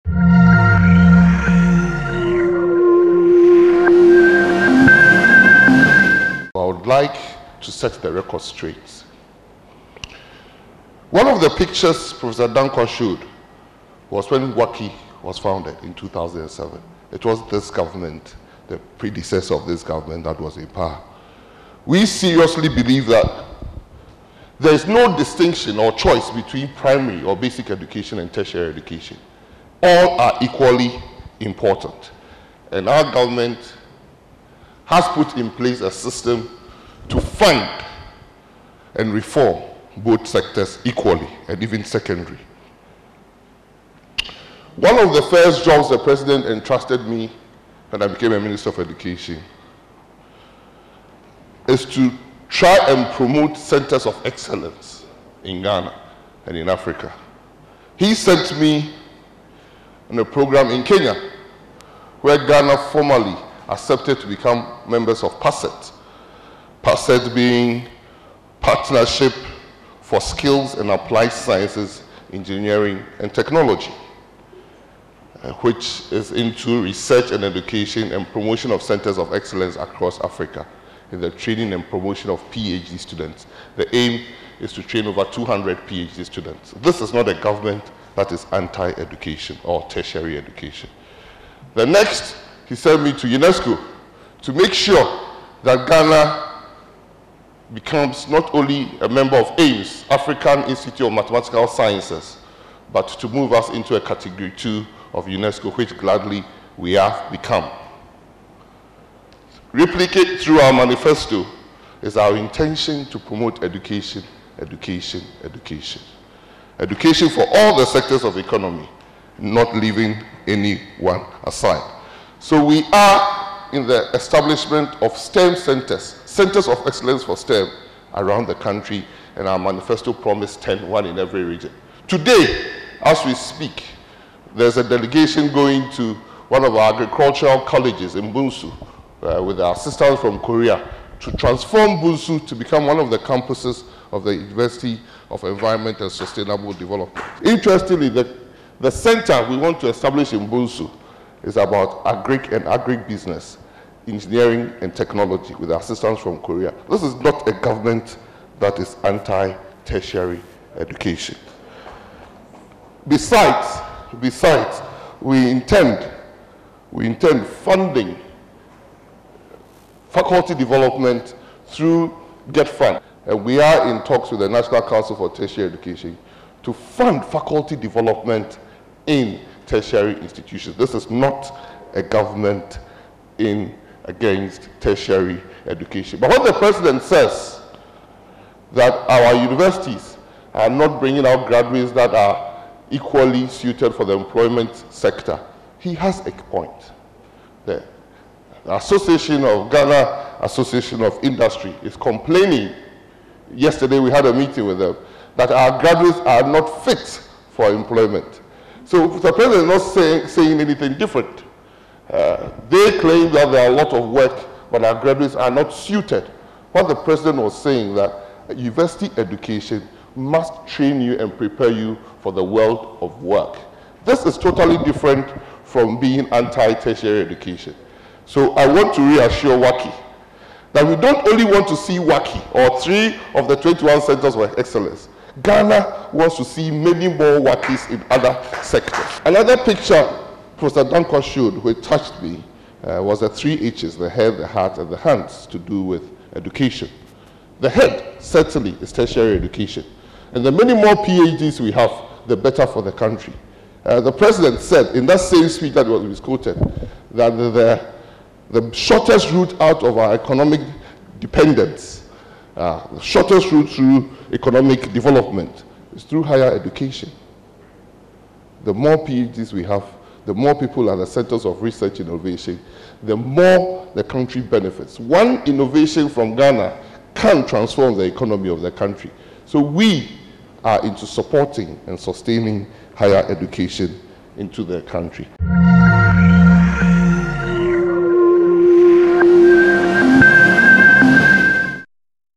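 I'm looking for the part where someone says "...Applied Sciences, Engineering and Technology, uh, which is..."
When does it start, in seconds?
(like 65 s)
70 s.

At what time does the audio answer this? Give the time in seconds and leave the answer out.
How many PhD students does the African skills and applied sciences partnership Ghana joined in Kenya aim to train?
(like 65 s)
85 s.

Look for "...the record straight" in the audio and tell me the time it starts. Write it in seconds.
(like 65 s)
8 s.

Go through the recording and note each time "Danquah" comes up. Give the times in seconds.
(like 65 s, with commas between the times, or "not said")
12 s, 240 s.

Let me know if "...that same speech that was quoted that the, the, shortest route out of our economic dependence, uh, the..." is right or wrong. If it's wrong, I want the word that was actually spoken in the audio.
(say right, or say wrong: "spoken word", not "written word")
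right.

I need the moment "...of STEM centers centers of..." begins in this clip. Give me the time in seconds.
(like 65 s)
125 s.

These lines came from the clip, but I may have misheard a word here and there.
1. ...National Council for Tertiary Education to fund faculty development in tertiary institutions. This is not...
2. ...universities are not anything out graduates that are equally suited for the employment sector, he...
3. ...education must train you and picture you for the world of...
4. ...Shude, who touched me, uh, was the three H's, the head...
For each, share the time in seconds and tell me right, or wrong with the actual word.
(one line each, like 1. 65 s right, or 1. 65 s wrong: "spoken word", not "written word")
1. 174 s right
2. 189 s wrong: "bringing", not "anything"
3. 219 s wrong: "prepare", not "picture"
4. 241 s right.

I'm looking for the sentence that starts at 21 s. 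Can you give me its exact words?
We seriously believe that there is no distinction or choice between primary or basic education and tertiary education.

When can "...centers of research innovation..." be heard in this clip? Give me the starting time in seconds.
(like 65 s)
271 s.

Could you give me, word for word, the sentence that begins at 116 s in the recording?
Education for all the sectors of the economy, not leaving anyone aside.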